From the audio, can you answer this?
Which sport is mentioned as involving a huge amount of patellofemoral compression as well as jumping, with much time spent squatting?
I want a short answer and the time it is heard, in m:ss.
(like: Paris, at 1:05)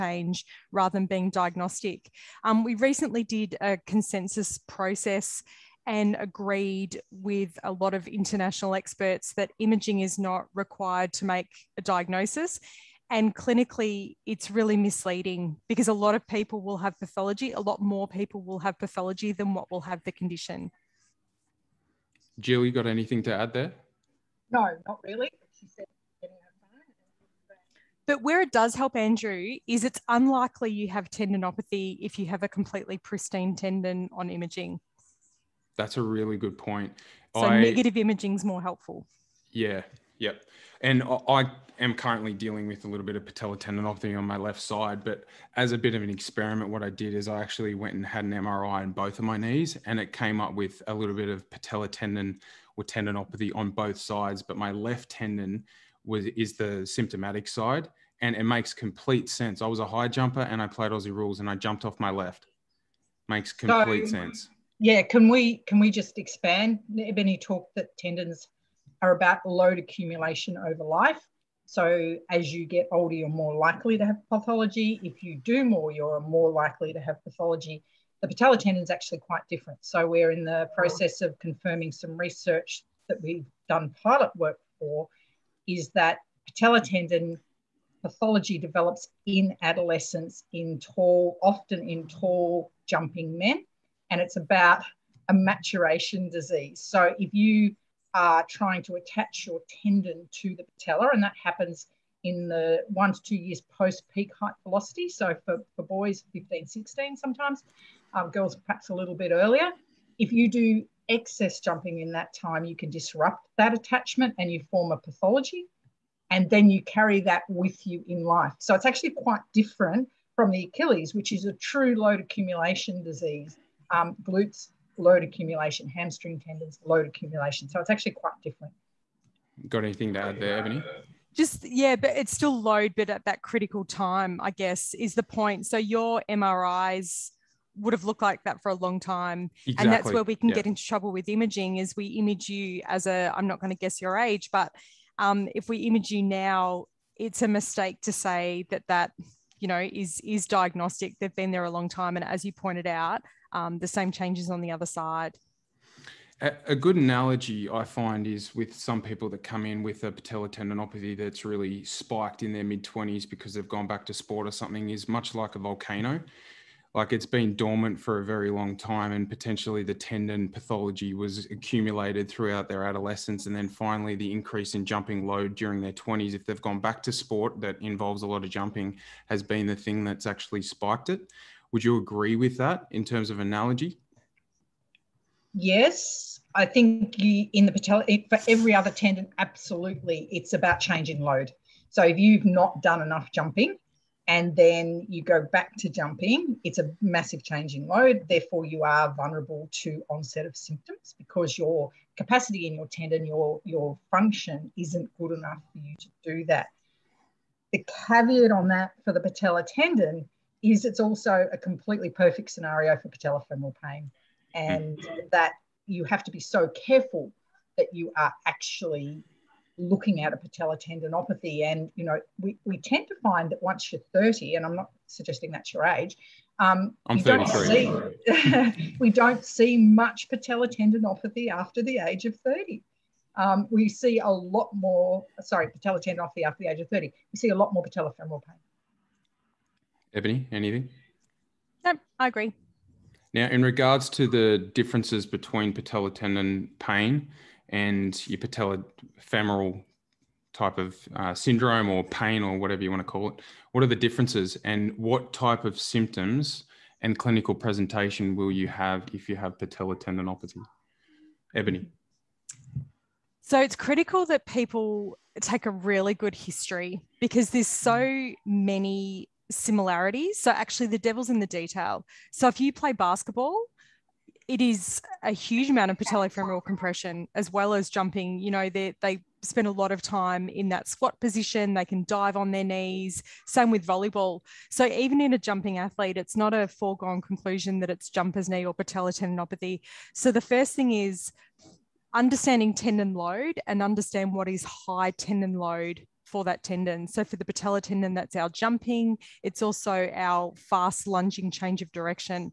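Basketball, at 4:32.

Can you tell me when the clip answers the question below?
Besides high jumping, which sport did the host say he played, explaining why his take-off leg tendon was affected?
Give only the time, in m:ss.
1:00.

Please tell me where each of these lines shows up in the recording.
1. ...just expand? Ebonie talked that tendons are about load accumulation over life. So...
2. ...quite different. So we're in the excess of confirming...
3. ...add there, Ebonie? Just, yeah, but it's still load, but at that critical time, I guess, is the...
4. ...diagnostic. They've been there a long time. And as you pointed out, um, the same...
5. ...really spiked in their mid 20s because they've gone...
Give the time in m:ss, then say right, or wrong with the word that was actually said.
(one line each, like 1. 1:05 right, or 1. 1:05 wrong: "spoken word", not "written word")
1. 1:05 right
2. 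1:19 wrong: "process", not "excess"
3. 2:10 right
4. 2:30 right
5. 2:41 right.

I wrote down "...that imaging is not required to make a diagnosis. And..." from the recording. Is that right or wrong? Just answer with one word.
right.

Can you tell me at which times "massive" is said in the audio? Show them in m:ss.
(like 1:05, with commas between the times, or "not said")
3:17.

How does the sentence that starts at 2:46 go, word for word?
Like it's been dormant for a very long time, and potentially the tendon pathology was accumulated throughout their adolescence.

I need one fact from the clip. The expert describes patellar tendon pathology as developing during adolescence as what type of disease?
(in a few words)
Maturation disease.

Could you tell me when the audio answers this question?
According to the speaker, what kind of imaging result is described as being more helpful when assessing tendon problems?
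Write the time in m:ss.
0:37.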